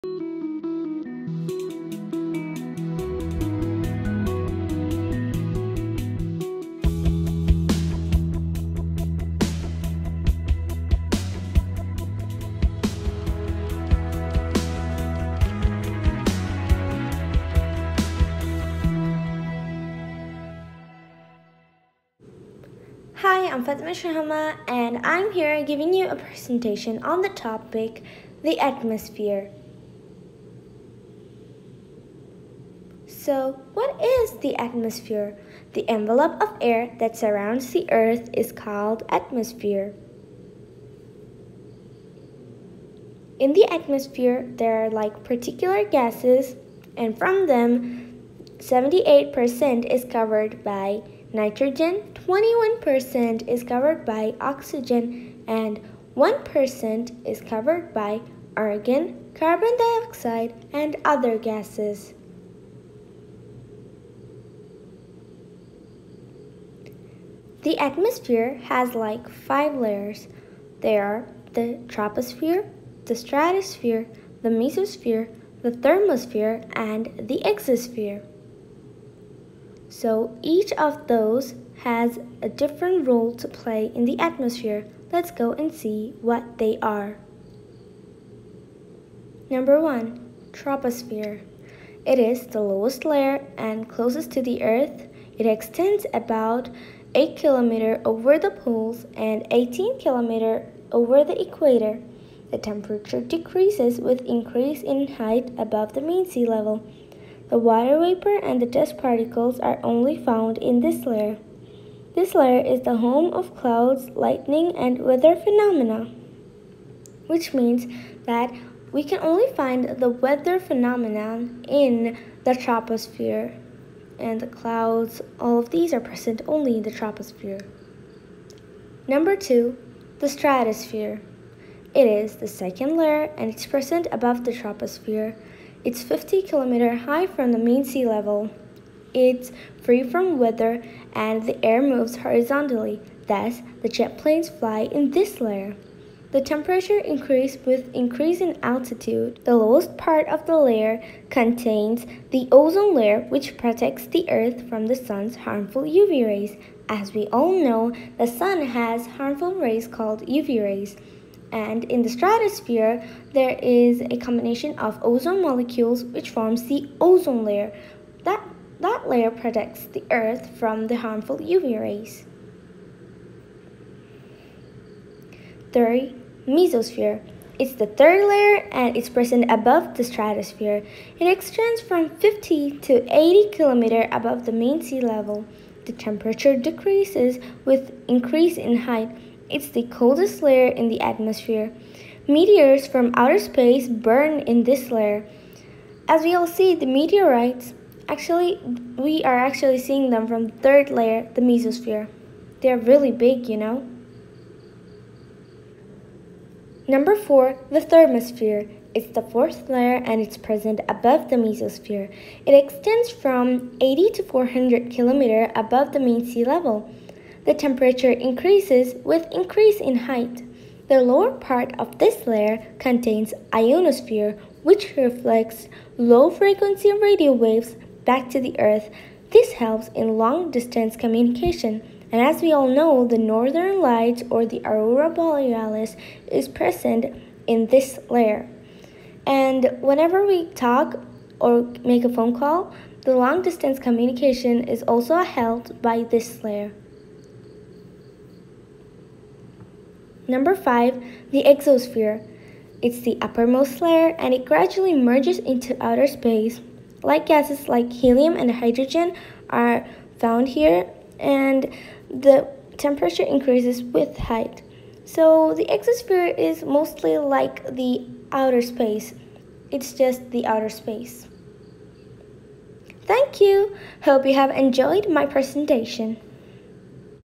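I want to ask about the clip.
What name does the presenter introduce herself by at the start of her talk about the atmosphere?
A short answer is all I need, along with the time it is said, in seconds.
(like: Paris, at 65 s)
Fatima Shahama, at 23 s.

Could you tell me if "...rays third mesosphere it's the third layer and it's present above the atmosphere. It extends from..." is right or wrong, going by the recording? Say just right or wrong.
wrong.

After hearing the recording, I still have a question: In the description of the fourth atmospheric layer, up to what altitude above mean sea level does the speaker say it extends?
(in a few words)
400 km.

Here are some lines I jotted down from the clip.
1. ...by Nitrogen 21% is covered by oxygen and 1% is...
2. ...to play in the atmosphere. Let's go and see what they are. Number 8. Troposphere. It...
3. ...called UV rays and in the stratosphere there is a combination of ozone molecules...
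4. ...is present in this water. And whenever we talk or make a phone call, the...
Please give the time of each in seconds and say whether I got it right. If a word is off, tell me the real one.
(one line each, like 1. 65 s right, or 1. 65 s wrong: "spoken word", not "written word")
1. 50 s right
2. 83 s wrong: "1", not "8"
3. 159 s right
4. 236 s wrong: "layer", not "water".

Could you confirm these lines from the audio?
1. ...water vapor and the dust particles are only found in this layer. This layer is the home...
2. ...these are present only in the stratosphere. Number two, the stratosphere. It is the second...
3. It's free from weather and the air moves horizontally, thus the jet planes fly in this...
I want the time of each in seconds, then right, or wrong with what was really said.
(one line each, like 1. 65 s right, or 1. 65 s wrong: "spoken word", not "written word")
1. 107 s right
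2. 125 s wrong: "troposphere", not "stratosphere"
3. 139 s right.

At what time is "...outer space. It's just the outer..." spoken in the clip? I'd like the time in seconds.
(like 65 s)
268 s.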